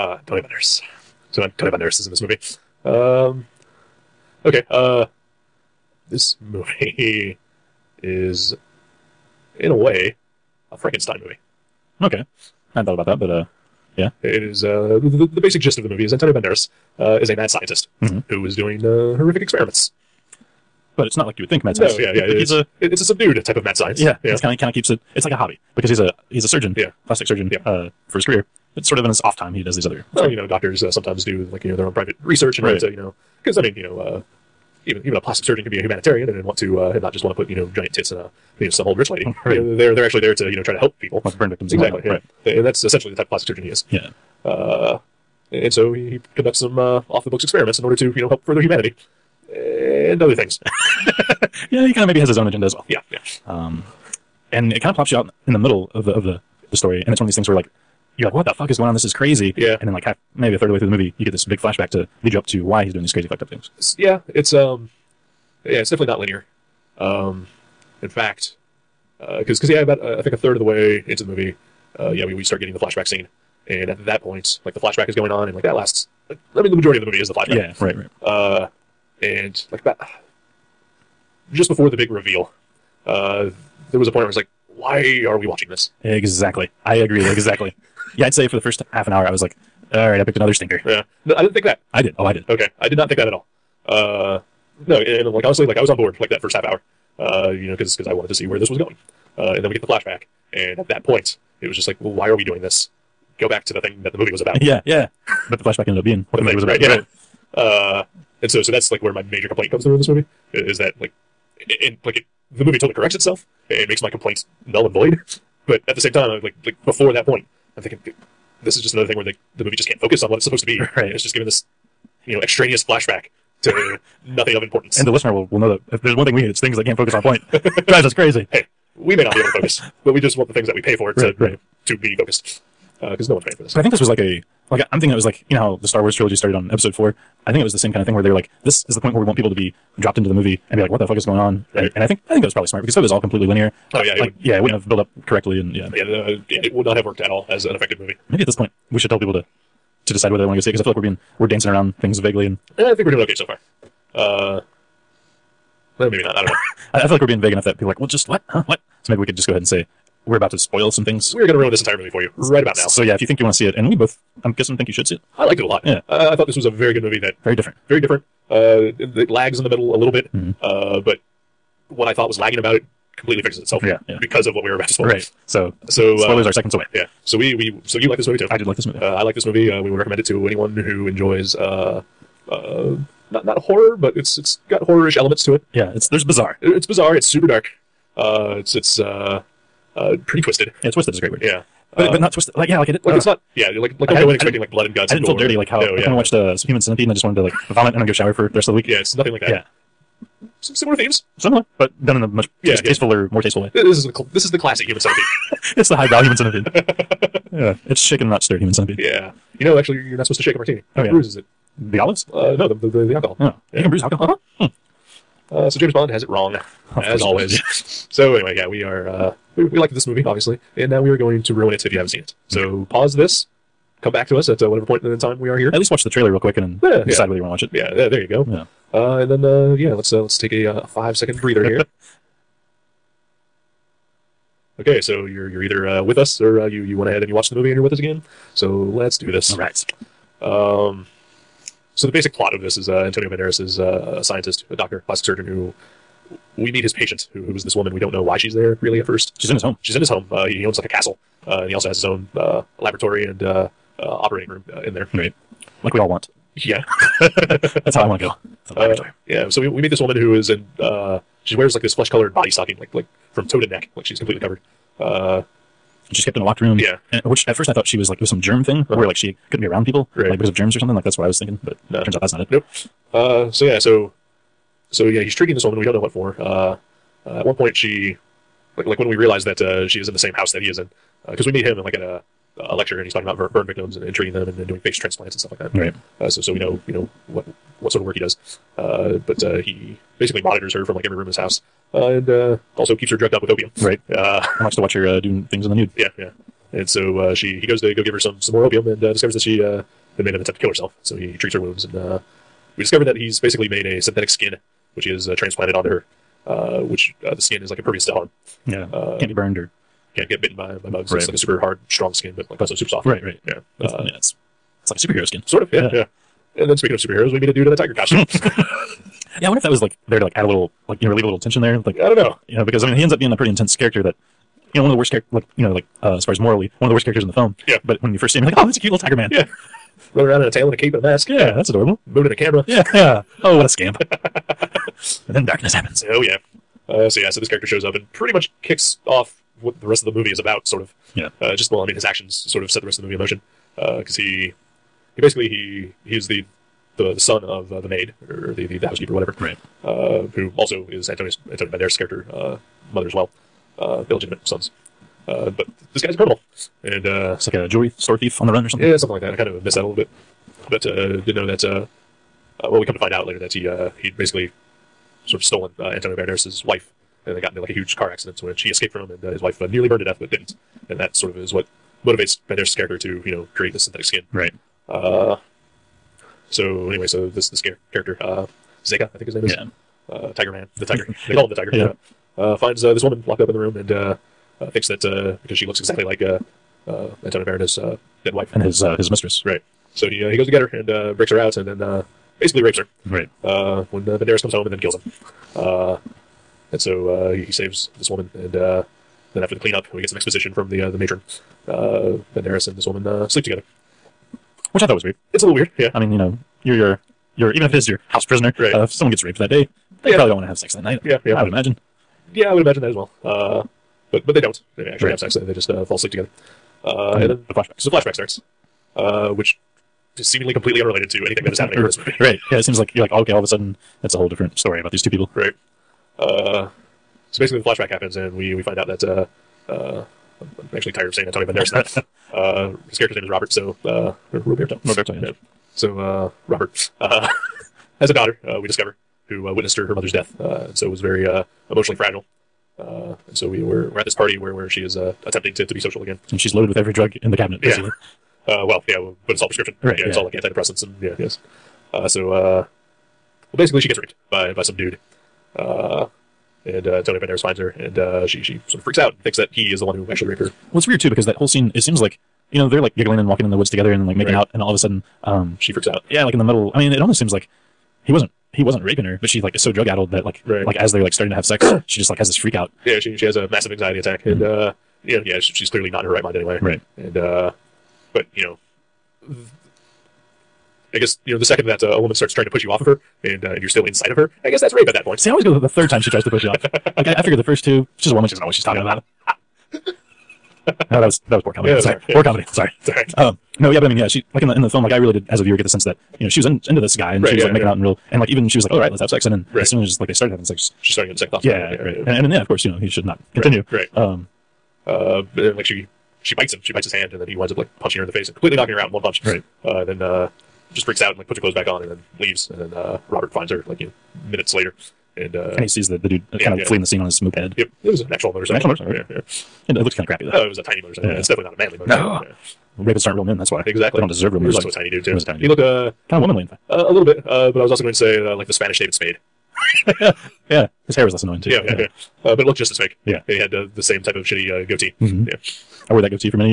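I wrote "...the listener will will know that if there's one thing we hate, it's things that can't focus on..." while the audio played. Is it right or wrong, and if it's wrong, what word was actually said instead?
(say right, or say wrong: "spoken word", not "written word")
right.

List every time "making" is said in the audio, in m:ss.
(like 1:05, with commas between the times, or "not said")
7:44, 8:17.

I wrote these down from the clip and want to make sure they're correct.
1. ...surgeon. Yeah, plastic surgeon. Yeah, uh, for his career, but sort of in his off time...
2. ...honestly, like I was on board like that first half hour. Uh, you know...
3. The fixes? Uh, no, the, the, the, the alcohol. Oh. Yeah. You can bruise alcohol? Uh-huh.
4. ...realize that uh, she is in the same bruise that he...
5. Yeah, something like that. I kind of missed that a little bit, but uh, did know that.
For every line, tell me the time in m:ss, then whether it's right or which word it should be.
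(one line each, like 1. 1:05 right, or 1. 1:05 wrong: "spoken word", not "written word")
1. 0:26 right
2. 1:35 right
3. 3:31 wrong: "olives", not "fixes"
4. 4:39 wrong: "house", not "bruise"
5. 5:58 right.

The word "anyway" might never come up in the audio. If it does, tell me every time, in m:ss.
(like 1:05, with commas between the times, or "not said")
3:38, 6:16, 7:56.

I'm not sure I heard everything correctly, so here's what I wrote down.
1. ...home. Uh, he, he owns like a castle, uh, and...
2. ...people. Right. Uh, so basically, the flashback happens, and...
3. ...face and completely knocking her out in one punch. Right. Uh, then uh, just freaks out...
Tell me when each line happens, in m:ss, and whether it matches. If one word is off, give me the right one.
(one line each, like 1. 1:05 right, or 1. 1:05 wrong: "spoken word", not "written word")
1. 4:10 right
2. 7:05 right
3. 8:28 right.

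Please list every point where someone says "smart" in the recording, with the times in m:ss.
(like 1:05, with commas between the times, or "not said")
2:22.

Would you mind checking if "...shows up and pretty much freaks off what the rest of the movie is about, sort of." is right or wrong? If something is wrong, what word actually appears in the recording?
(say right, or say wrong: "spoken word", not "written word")
wrong: "kicks", not "freaks".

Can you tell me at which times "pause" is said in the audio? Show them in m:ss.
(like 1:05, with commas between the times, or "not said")
3:42.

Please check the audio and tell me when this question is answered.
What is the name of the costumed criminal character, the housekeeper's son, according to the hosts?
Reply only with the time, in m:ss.
6:18.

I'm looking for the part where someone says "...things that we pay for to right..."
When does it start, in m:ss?
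2:10.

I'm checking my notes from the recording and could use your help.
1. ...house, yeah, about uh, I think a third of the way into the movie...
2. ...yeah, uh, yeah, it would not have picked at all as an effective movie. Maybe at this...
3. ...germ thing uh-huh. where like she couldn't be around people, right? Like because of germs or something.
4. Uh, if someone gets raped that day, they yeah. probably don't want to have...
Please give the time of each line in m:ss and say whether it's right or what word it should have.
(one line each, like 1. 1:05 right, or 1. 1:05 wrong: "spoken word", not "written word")
1. 1:09 wrong: "cause", not "house"
2. 2:25 wrong: "worked", not "picked"
3. 4:28 right
4. 6:48 right.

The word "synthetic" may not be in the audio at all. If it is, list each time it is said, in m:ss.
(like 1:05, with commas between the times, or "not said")
5:04, 6:13.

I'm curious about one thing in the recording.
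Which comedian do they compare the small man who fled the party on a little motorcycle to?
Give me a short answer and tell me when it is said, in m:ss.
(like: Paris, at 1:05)
David Spade, at 8:48.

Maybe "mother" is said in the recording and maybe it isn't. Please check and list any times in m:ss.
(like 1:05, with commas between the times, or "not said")
5:52, 7:19.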